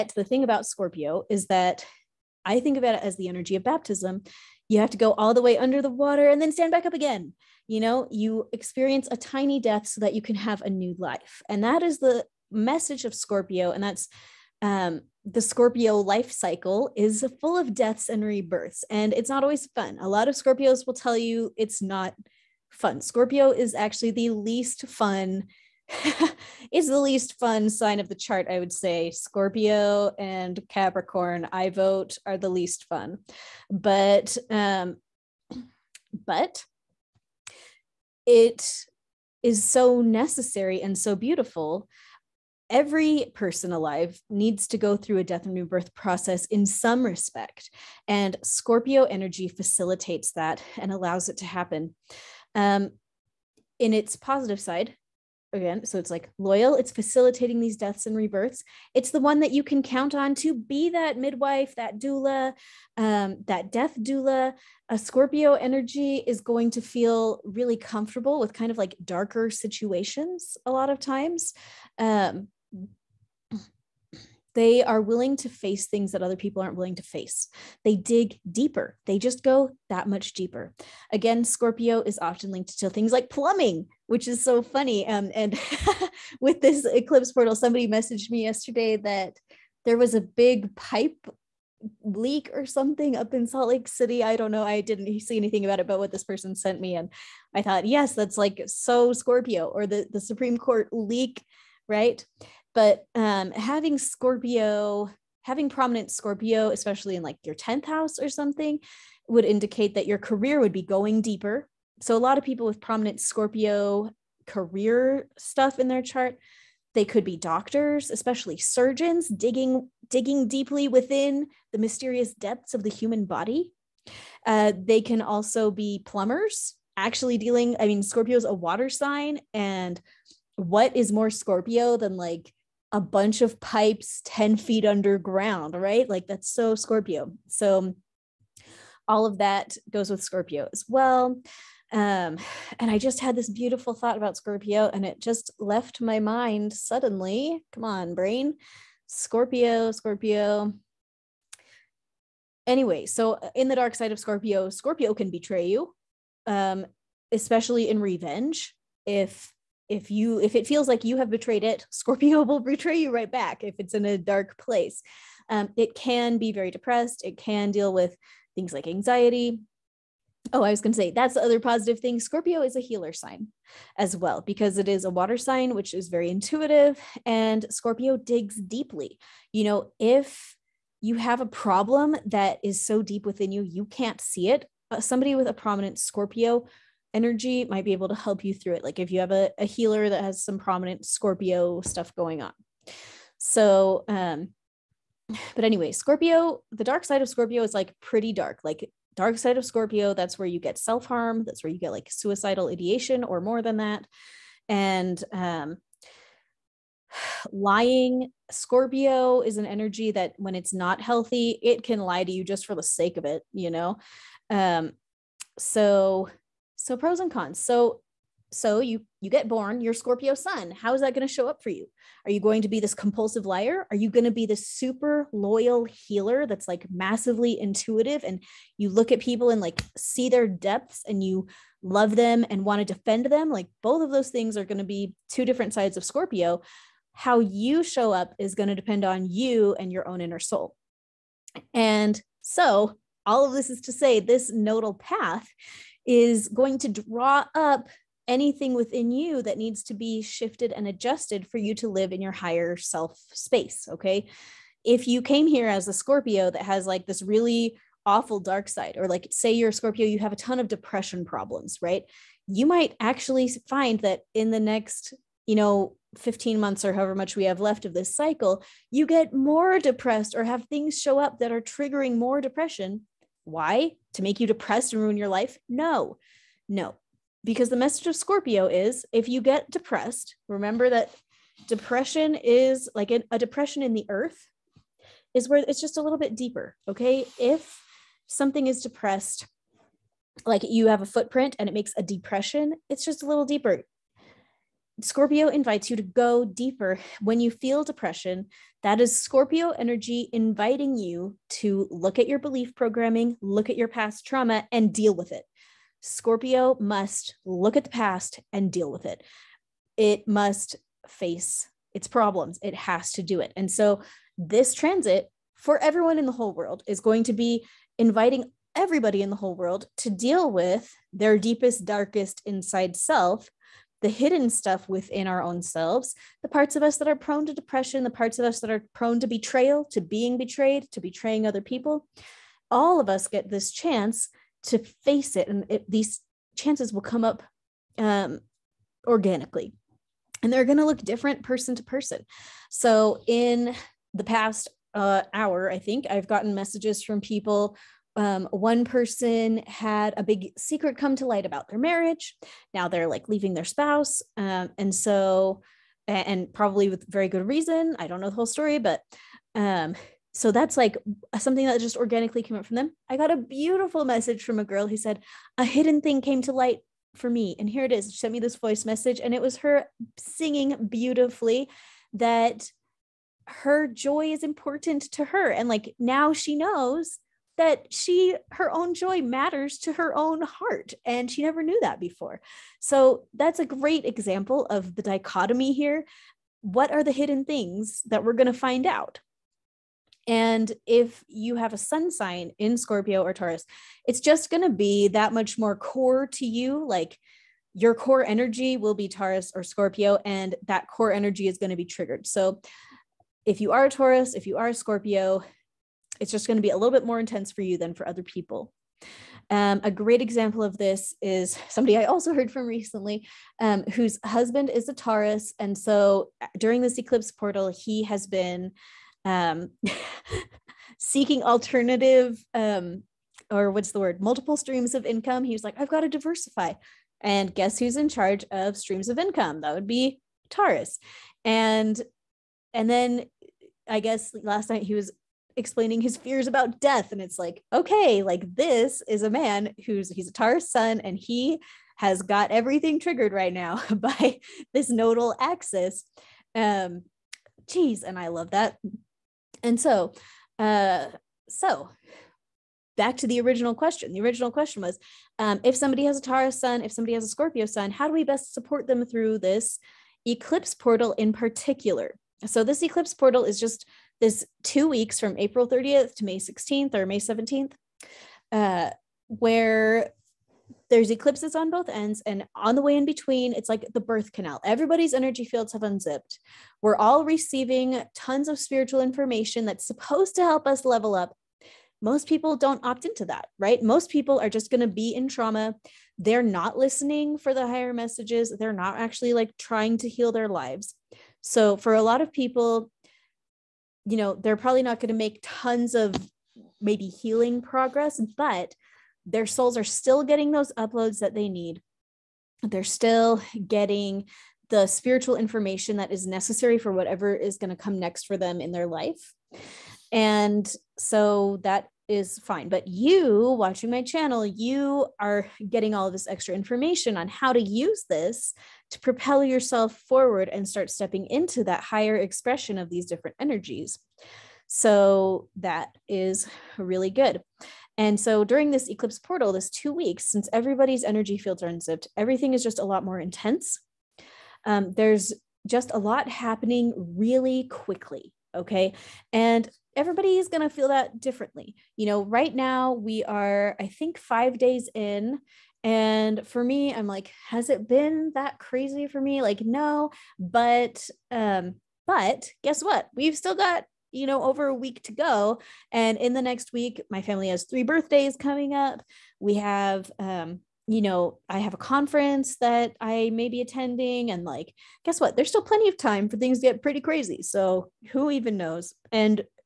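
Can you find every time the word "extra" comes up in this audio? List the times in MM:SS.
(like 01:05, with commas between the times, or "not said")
08:36.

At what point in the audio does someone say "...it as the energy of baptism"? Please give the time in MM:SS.
00:02.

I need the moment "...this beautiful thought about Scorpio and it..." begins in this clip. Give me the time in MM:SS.
02:23.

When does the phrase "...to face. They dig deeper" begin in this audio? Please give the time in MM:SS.
01:16.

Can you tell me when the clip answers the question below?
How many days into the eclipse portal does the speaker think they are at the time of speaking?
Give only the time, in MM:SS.
09:04.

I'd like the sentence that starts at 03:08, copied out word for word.
Like if you have a, a healer that has some prominent Scorpio stuff going on.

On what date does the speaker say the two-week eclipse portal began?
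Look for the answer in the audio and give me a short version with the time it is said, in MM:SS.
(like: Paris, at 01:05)
April 30th, at 07:45.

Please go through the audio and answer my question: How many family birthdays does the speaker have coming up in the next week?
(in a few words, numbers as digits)
3.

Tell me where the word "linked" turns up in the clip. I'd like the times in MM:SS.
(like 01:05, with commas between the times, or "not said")
01:22.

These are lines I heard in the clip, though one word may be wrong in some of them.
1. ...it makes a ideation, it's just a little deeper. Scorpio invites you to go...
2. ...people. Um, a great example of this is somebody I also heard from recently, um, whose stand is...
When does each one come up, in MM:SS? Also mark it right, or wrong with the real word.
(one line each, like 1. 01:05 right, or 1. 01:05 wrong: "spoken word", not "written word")
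1. 04:51 wrong: "depression", not "ideation"
2. 06:48 wrong: "husband", not "stand".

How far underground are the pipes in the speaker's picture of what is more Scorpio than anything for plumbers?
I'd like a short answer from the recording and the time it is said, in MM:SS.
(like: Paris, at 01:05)
10 feet, at 02:14.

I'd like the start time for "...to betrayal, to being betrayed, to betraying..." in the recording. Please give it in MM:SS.
05:29.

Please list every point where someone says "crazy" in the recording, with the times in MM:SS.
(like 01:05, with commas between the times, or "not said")
09:08, 09:26.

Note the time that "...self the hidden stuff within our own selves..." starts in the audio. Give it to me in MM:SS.
05:22.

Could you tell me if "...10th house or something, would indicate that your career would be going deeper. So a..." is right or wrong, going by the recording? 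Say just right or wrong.
right.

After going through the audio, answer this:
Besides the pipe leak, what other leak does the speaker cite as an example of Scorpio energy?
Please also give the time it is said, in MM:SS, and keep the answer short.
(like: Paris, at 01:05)
Supreme Court, at 01:40.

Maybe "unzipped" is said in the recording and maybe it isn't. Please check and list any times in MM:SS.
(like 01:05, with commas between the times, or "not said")
07:55, 08:51.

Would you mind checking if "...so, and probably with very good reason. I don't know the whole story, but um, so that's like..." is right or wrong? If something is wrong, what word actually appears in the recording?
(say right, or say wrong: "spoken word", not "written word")
right.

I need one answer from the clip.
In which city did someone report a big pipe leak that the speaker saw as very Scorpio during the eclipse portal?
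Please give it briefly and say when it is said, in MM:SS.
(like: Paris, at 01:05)
Salt Lake City, at 01:33.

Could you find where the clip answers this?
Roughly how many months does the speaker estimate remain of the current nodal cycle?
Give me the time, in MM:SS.
04:26.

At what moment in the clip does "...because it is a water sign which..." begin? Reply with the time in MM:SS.
02:54.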